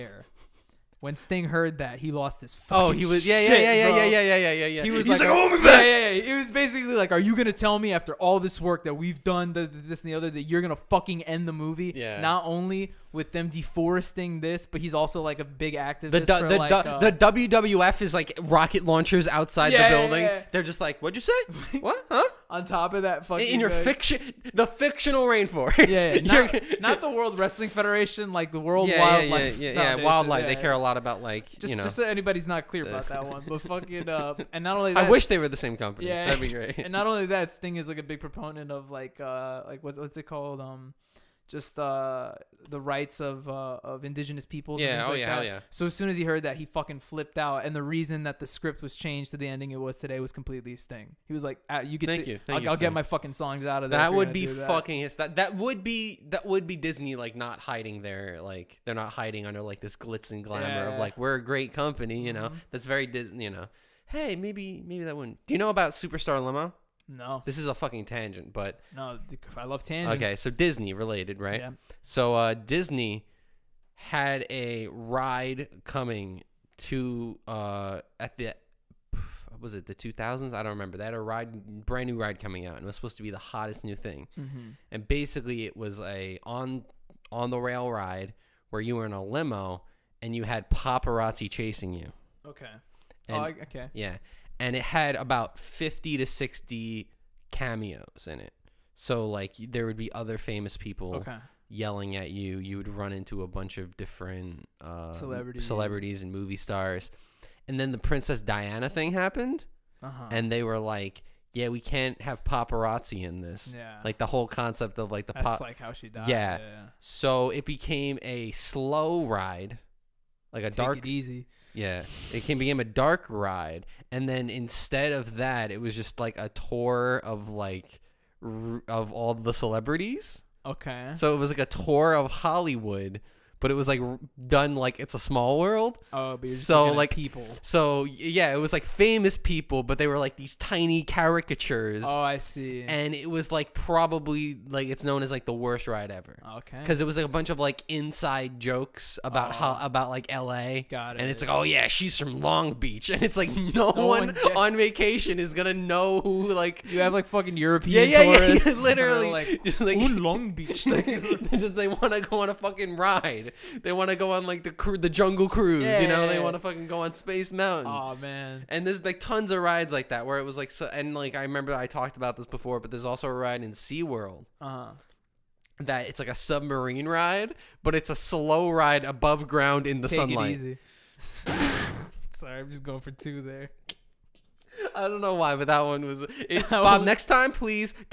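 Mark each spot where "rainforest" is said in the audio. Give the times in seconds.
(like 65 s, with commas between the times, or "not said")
25 s.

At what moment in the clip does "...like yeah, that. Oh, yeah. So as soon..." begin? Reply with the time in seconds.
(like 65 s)
45 s.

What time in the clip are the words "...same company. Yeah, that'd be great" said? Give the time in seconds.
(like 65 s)
35 s.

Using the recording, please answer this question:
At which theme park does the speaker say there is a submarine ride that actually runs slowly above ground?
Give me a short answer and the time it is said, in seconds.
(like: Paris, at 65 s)
SeaWorld, at 173 s.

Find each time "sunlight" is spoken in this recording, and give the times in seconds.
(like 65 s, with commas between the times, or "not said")
180 s.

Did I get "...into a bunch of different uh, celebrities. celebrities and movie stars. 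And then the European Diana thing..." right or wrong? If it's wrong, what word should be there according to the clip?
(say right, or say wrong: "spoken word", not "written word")
wrong: "Princess", not "European".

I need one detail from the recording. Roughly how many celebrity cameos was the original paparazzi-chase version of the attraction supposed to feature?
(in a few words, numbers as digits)
50 to 60.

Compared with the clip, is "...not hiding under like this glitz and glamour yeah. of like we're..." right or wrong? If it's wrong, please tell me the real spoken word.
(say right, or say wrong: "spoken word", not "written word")
right.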